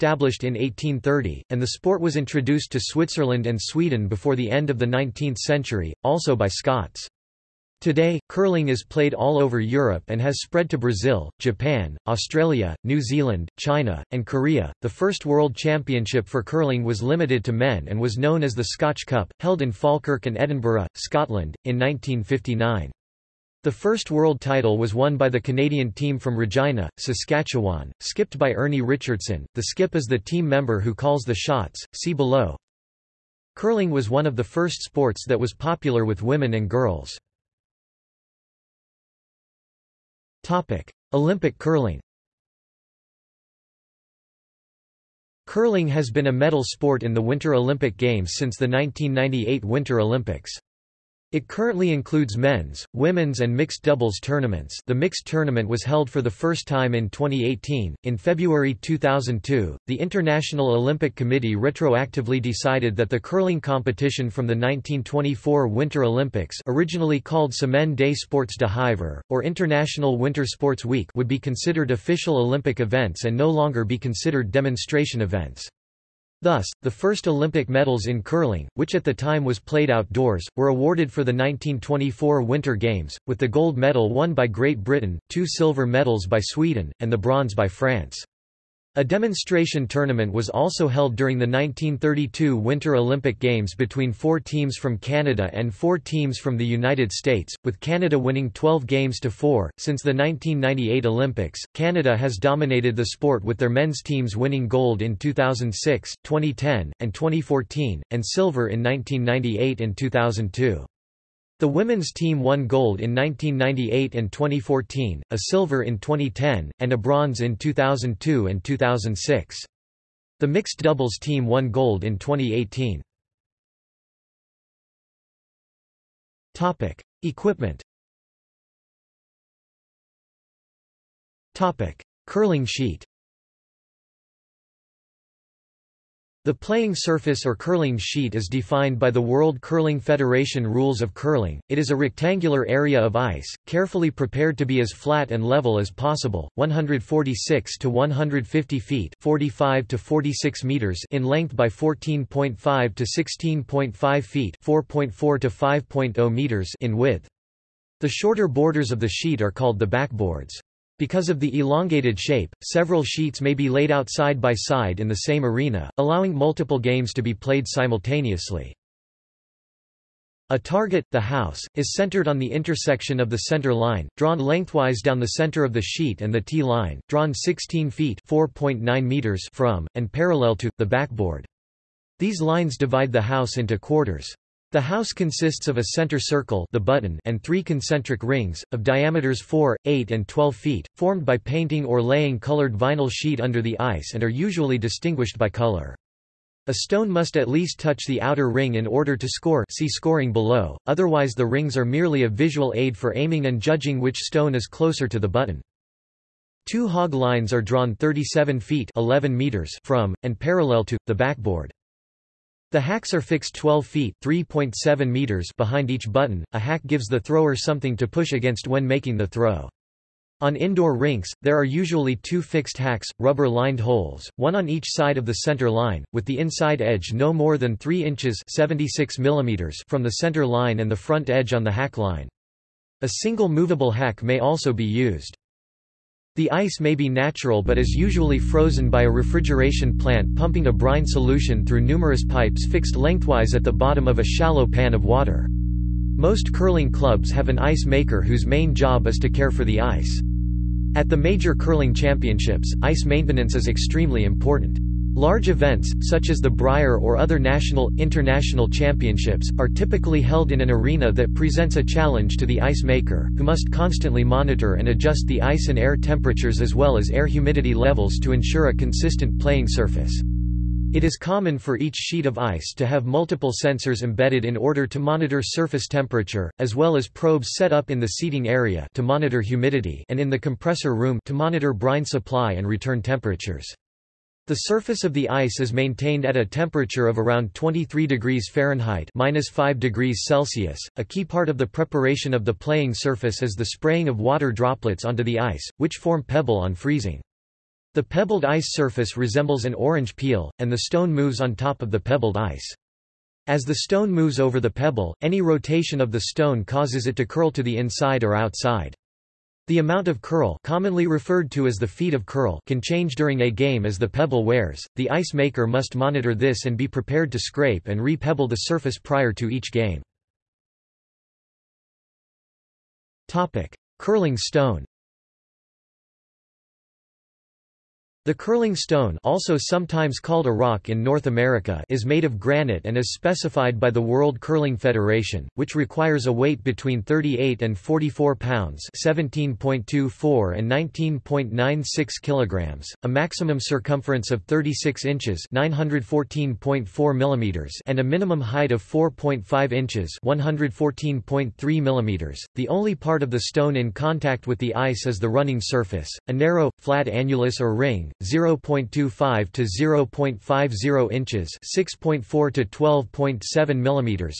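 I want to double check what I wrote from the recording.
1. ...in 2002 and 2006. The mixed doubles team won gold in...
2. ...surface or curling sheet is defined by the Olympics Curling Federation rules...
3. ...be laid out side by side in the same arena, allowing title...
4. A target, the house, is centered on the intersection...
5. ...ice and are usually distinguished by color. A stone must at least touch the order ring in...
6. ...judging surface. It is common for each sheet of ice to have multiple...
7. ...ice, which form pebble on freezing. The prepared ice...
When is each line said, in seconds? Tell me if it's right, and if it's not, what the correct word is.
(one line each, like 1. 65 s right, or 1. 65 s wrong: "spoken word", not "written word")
1. 117 s right
2. 136 s wrong: "World", not "Olympics"
3. 163 s wrong: "multiple", not "title"
4. 170 s right
5. 193 s wrong: "outer", not "order"
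6. 269 s wrong: "playing", not "judging"
7. 295 s wrong: "pebbled", not "prepared".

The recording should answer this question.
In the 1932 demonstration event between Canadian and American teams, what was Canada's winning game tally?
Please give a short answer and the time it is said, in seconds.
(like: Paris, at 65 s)
12 games to 4, at 98 s.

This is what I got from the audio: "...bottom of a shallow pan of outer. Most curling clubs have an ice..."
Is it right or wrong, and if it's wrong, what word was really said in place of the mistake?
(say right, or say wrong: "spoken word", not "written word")
wrong: "water", not "outer".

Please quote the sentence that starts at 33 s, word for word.
Curling was one of the first sports that was popular with women and girls.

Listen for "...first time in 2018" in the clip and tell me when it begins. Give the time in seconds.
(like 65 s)
56 s.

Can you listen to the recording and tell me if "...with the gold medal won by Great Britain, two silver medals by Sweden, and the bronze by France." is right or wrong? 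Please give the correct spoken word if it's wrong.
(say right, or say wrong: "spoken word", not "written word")
right.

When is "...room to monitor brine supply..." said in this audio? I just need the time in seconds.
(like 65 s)
280 s.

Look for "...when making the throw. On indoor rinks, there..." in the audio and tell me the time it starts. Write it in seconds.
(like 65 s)
218 s.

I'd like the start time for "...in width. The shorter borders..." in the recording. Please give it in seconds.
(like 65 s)
156 s.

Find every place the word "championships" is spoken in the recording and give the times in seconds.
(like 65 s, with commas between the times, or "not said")
15 s, 251 s, 258 s.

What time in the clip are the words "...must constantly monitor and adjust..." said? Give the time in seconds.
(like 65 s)
263 s.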